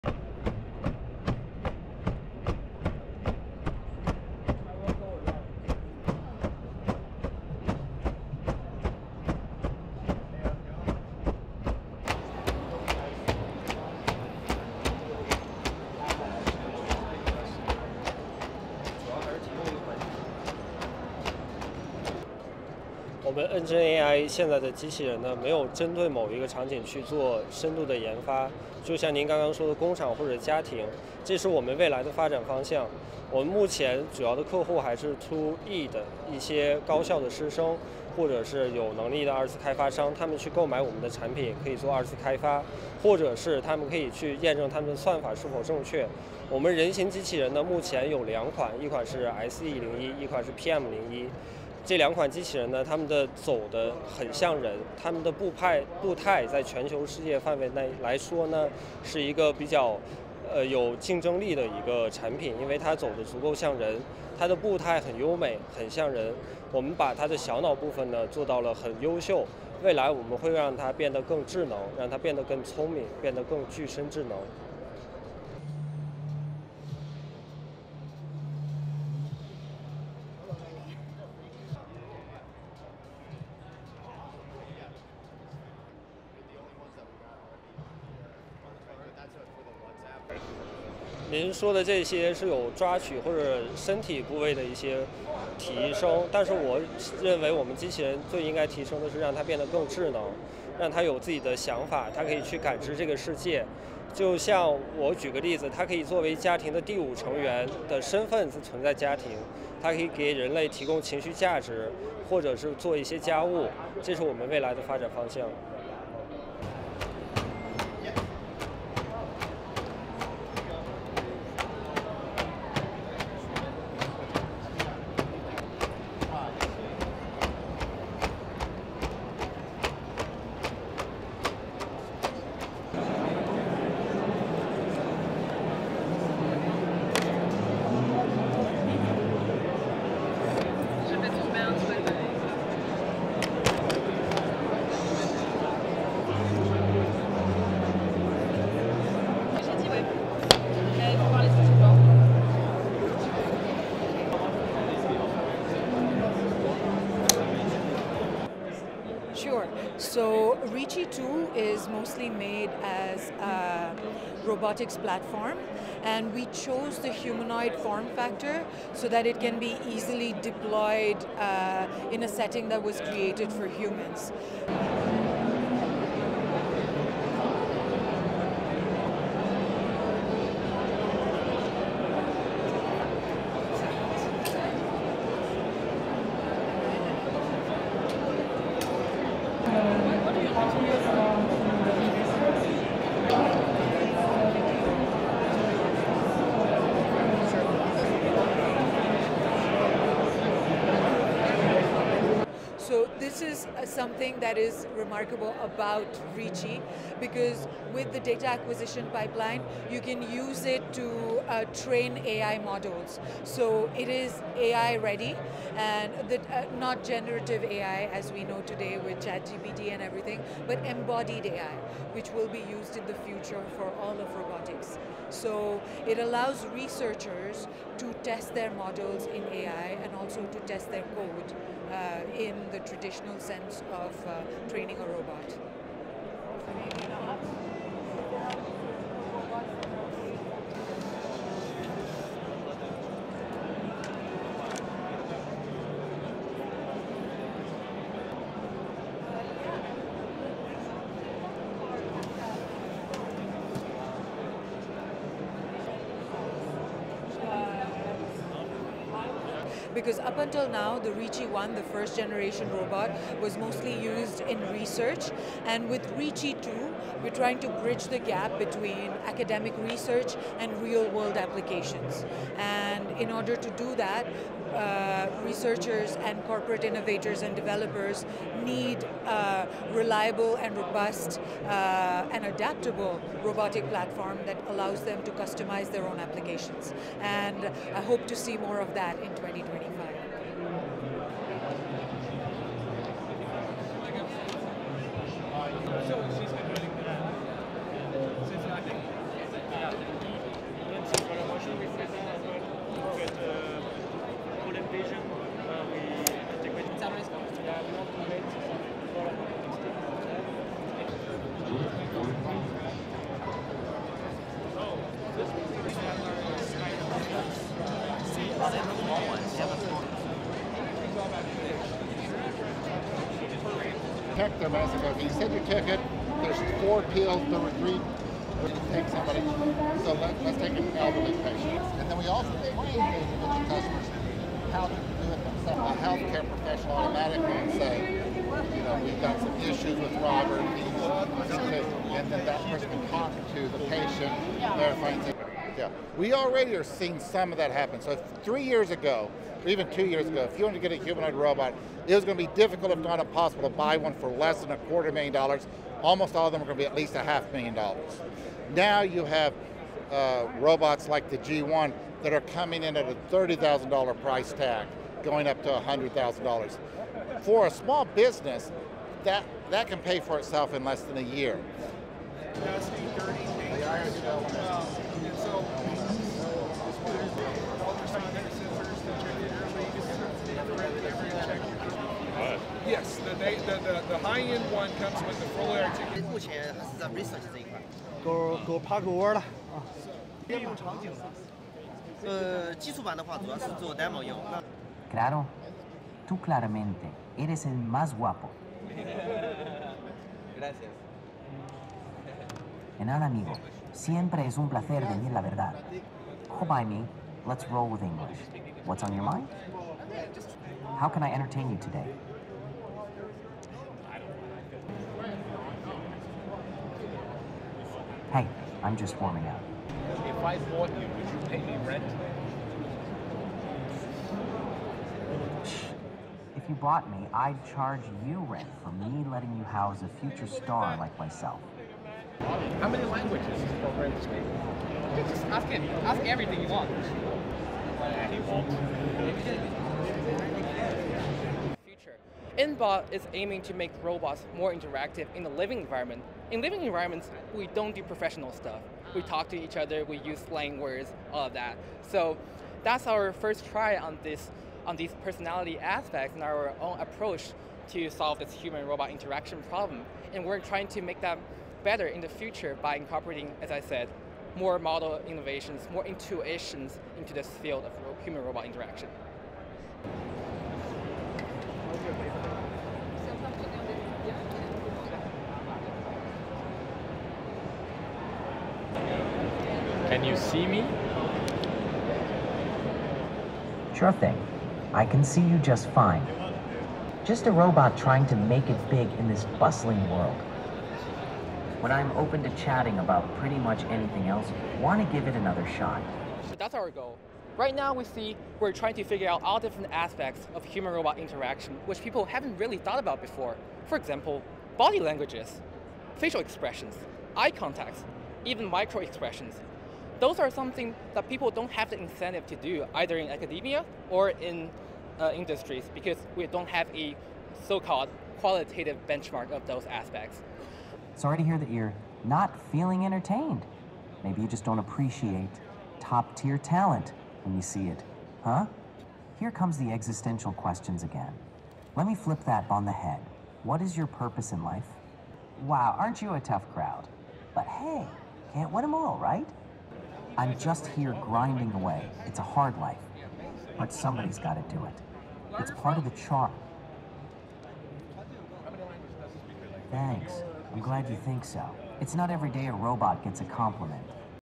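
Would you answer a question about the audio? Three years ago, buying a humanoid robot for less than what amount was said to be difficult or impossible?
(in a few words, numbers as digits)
a quarter million dollars.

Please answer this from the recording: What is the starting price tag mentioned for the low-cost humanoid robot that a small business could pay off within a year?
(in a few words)
$30,000.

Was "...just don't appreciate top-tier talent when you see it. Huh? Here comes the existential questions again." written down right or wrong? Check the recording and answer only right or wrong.
right.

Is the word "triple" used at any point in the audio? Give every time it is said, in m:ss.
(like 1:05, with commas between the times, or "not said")
not said.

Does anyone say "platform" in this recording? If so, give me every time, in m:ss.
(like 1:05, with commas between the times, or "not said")
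2:44, 4:43.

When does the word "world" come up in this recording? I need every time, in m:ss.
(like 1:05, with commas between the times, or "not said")
4:31, 8:10.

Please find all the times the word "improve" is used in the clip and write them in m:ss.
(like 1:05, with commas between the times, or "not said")
not said.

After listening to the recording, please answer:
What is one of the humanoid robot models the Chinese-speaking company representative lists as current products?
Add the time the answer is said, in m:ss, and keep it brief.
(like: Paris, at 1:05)
SE01, at 0:49.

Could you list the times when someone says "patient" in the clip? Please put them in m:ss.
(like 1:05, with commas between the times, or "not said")
5:31, 5:43.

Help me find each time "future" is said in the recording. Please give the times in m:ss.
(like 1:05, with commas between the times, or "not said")
3:43, 7:10, 7:42.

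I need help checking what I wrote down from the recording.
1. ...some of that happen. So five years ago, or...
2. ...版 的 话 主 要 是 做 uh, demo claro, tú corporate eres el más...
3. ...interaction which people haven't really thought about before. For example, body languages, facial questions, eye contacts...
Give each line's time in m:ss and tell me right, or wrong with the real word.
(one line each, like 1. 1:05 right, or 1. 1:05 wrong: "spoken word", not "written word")
1. 5:47 wrong: "three", not "five"
2. 6:33 wrong: "claramente", not "corporate"
3. 8:21 wrong: "expressions", not "questions".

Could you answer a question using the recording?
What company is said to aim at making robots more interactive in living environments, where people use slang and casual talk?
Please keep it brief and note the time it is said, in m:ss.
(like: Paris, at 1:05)
IntBot, at 7:22.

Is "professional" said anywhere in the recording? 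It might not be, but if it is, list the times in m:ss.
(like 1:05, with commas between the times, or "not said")
5:36, 7:28.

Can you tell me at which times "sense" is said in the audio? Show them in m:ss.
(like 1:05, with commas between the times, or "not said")
3:53.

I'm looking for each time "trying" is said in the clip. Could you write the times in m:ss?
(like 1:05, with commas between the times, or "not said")
4:27, 7:40, 8:07, 8:18.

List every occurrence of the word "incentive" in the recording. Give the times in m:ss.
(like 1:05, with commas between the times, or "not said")
8:31.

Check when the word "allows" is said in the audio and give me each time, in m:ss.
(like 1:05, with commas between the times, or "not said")
3:46, 4:44.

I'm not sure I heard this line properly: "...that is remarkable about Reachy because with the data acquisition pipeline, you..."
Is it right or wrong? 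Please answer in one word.
right.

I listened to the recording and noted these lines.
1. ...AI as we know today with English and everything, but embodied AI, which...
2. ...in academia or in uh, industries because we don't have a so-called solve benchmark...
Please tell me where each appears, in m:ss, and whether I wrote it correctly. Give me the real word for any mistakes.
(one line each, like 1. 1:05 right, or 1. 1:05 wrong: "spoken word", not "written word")
1. 3:37 wrong: "ChatGPT", not "English"
2. 8:33 wrong: "qualitative", not "solve".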